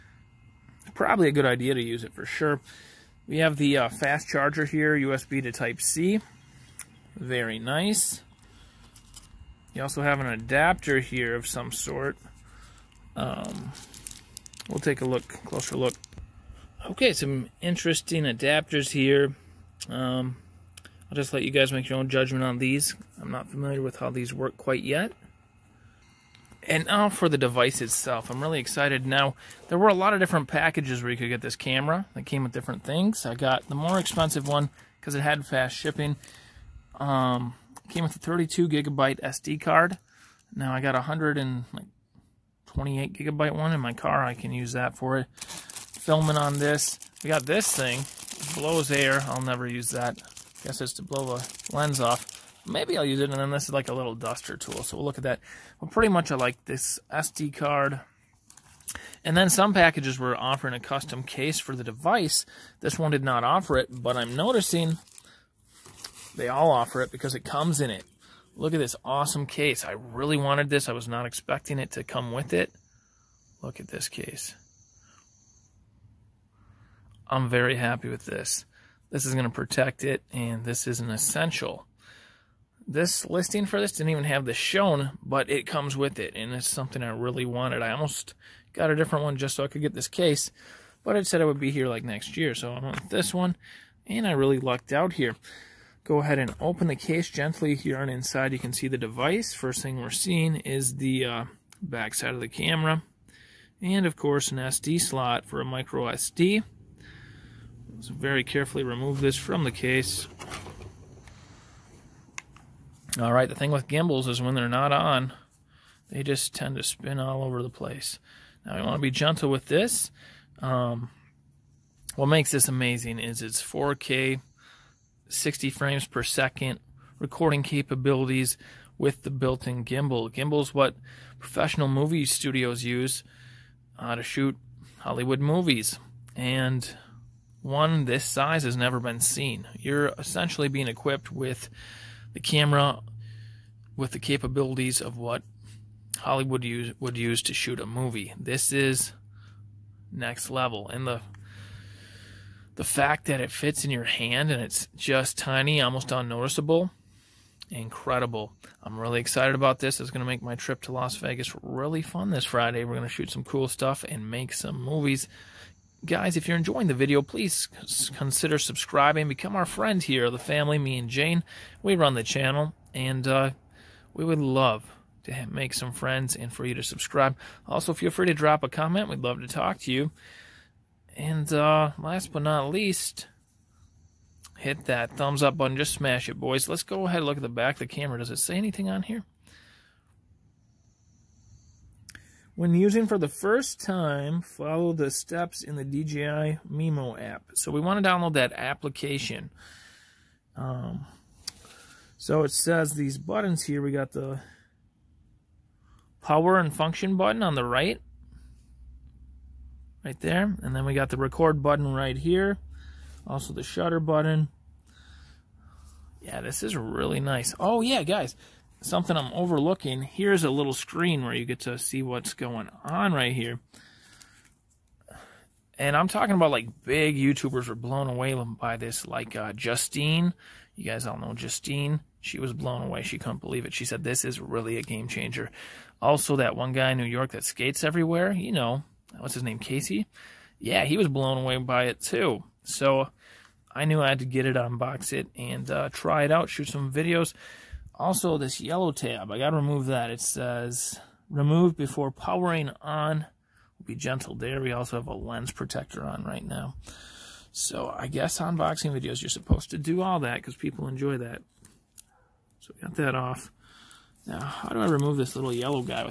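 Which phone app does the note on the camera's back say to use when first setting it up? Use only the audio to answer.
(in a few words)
DJI Mimo.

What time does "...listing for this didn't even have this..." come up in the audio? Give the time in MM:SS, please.
01:23.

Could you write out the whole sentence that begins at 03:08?
Does it say anything on here?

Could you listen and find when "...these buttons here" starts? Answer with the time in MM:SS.
03:22.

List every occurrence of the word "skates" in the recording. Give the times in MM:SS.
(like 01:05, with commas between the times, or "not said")
03:57.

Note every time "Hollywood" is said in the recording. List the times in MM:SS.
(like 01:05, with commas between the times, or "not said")
02:14, 02:26.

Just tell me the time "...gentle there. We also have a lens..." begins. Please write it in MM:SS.
04:13.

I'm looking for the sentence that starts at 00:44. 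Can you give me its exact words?
I can use that for it filming on this.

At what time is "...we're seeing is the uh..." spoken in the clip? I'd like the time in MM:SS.
01:39.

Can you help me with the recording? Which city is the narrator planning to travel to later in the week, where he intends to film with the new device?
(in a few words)
Las Vegas.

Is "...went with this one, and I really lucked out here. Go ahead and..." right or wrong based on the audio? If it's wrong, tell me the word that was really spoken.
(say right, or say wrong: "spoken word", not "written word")
right.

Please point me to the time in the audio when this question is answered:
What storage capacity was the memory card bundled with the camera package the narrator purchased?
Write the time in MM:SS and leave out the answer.
00:38.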